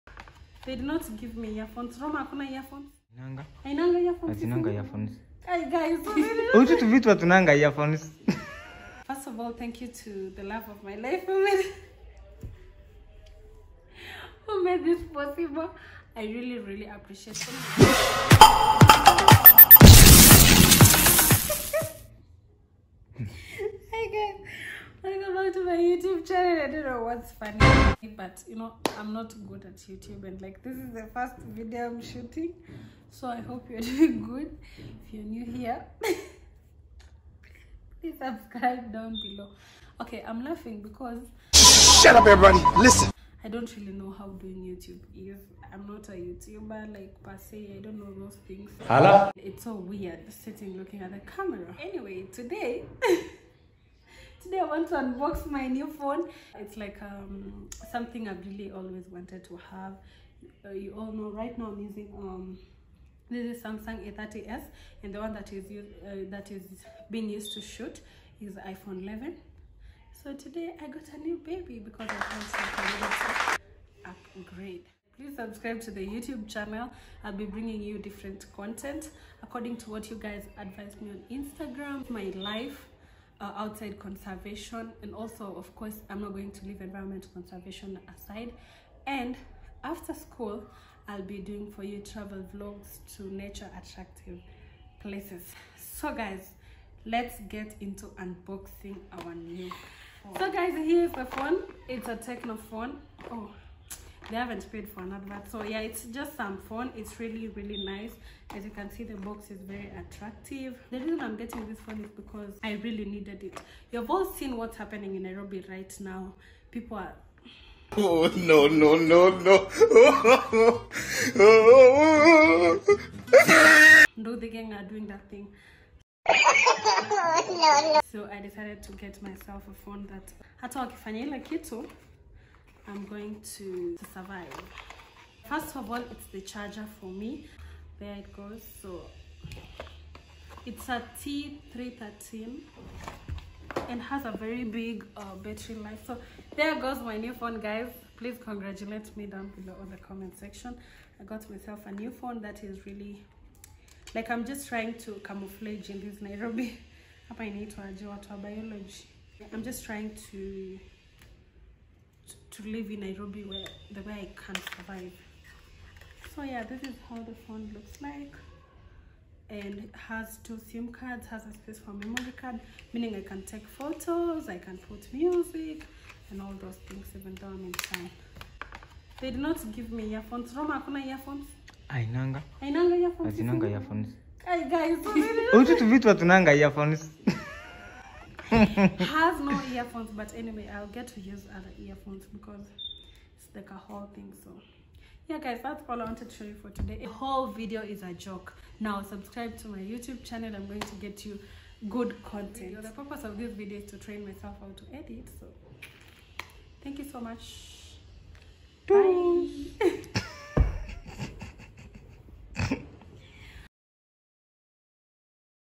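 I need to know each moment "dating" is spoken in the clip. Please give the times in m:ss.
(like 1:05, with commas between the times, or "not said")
not said.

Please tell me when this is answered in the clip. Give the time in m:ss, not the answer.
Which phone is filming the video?
1:08.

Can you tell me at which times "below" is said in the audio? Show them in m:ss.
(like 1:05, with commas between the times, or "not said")
0:39, 2:29.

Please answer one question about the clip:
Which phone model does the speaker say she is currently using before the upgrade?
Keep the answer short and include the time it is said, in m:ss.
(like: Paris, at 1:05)
Samsung A30s, at 1:03.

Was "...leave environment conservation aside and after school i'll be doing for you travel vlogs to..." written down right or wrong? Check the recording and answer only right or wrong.
right.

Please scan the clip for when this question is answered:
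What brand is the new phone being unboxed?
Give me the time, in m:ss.
1:42.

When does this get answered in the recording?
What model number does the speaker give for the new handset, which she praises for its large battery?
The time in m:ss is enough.
2:21.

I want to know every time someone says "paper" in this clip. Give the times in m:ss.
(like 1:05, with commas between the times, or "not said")
not said.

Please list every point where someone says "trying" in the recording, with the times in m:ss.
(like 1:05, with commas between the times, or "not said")
2:34, 2:39.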